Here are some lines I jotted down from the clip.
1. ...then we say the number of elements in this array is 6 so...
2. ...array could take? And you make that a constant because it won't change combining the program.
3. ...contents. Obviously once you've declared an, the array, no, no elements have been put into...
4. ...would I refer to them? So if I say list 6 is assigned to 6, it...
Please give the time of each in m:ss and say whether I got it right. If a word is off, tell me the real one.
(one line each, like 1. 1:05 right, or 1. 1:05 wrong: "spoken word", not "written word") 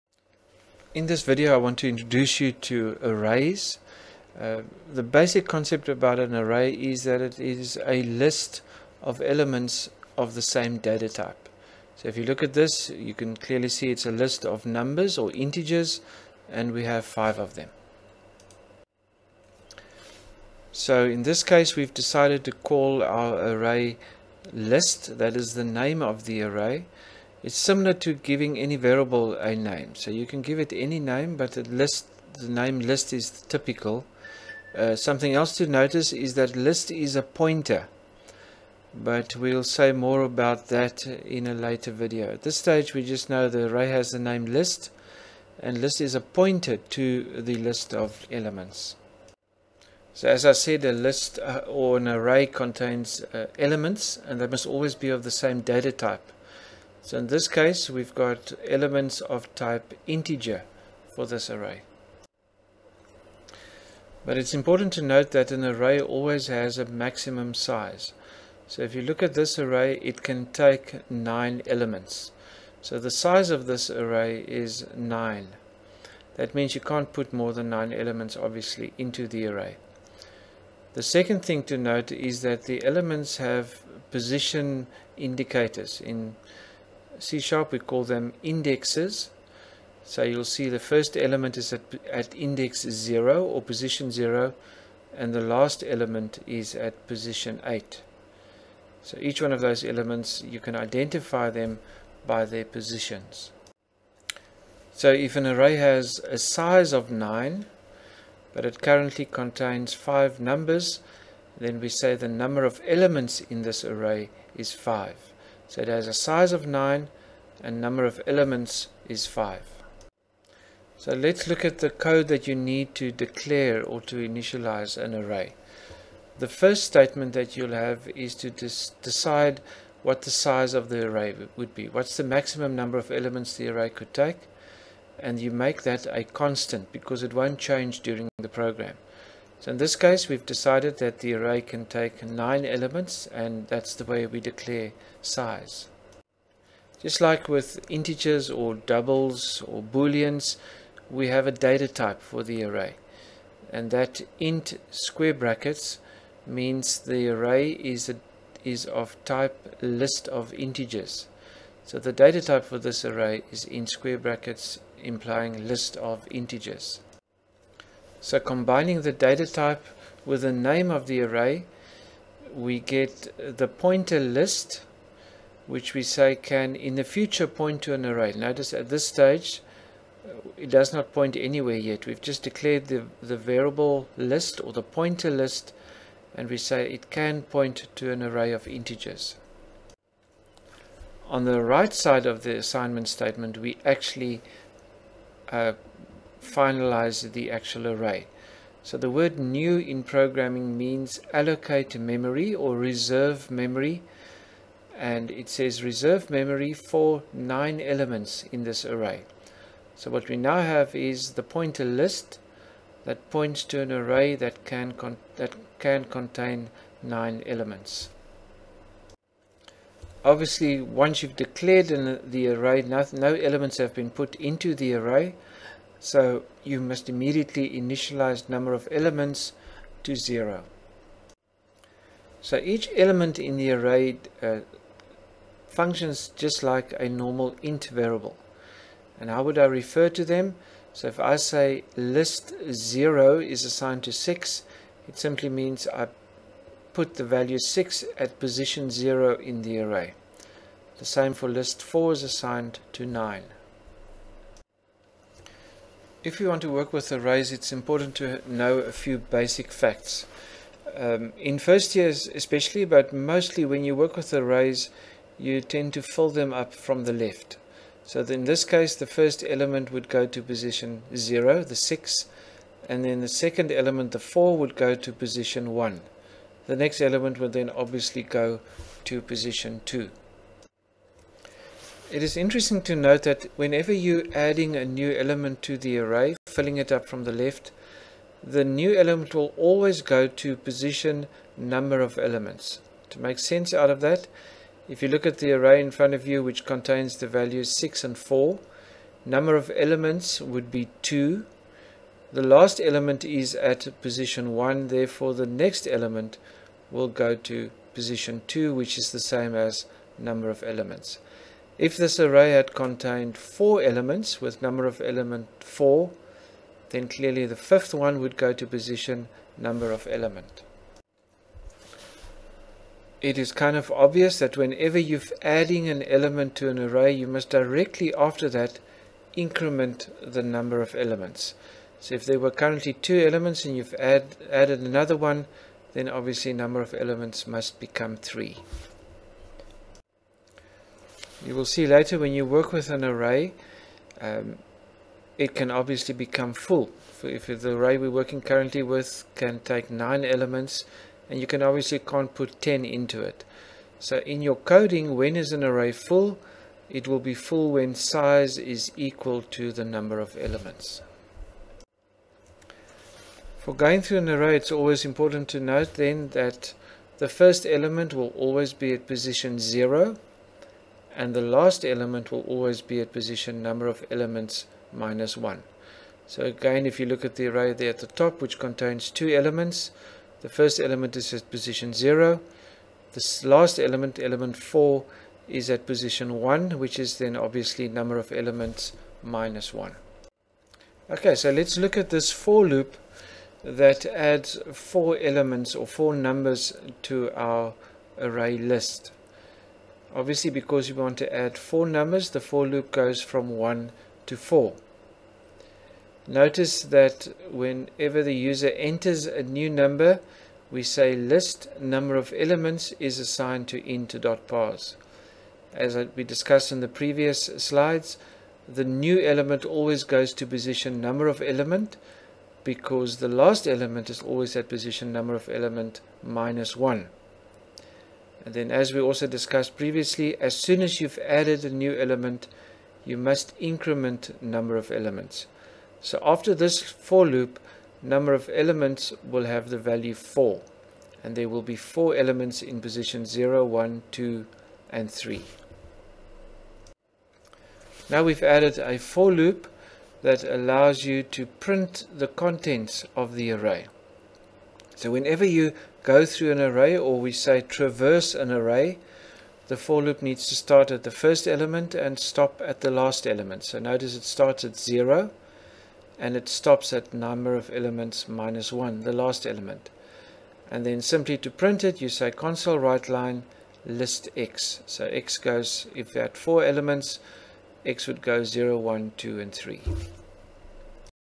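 1. 1:51 wrong: "5", not "6"
2. 2:13 wrong: "during", not "combining"
3. 3:37 wrong: "elements", not "contents"
4. 3:59 wrong: "0", not "6".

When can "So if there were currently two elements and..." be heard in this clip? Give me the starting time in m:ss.
5:31.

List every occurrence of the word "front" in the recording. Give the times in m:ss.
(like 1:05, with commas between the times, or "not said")
4:55.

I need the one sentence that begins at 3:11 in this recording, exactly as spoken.
On the right side of the assignment statement, we actually uh, finalize the actual array.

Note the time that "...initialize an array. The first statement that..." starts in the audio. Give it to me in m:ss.
2:04.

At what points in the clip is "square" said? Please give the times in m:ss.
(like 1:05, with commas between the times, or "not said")
2:34, 2:43.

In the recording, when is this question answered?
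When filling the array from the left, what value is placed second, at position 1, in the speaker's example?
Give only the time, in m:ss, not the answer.
4:34.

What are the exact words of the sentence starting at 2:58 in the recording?
Notice at this stage, it does not point anywhere yet.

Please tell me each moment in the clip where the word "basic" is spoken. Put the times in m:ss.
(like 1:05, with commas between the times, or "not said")
0:05, 4:19.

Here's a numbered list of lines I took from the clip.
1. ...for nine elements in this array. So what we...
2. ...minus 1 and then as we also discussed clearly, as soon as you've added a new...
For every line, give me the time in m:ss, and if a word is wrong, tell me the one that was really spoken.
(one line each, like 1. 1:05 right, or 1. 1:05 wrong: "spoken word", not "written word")
1. 3:26 right
2. 7:06 wrong: "previously", not "clearly".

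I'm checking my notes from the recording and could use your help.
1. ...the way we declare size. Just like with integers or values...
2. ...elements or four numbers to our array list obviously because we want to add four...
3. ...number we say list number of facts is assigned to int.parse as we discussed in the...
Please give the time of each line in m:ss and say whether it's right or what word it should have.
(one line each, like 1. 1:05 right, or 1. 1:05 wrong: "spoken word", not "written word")
1. 2:23 wrong: "doubles", not "values"
2. 6:35 right
3. 6:49 wrong: "elements", not "facts".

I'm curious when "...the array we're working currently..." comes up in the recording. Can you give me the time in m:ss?
5:47.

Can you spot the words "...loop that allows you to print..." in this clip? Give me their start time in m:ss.
7:29.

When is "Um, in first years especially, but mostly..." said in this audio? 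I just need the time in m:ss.
4:20.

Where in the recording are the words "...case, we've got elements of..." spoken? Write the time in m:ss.
0:57.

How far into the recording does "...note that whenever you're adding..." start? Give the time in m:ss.
4:42.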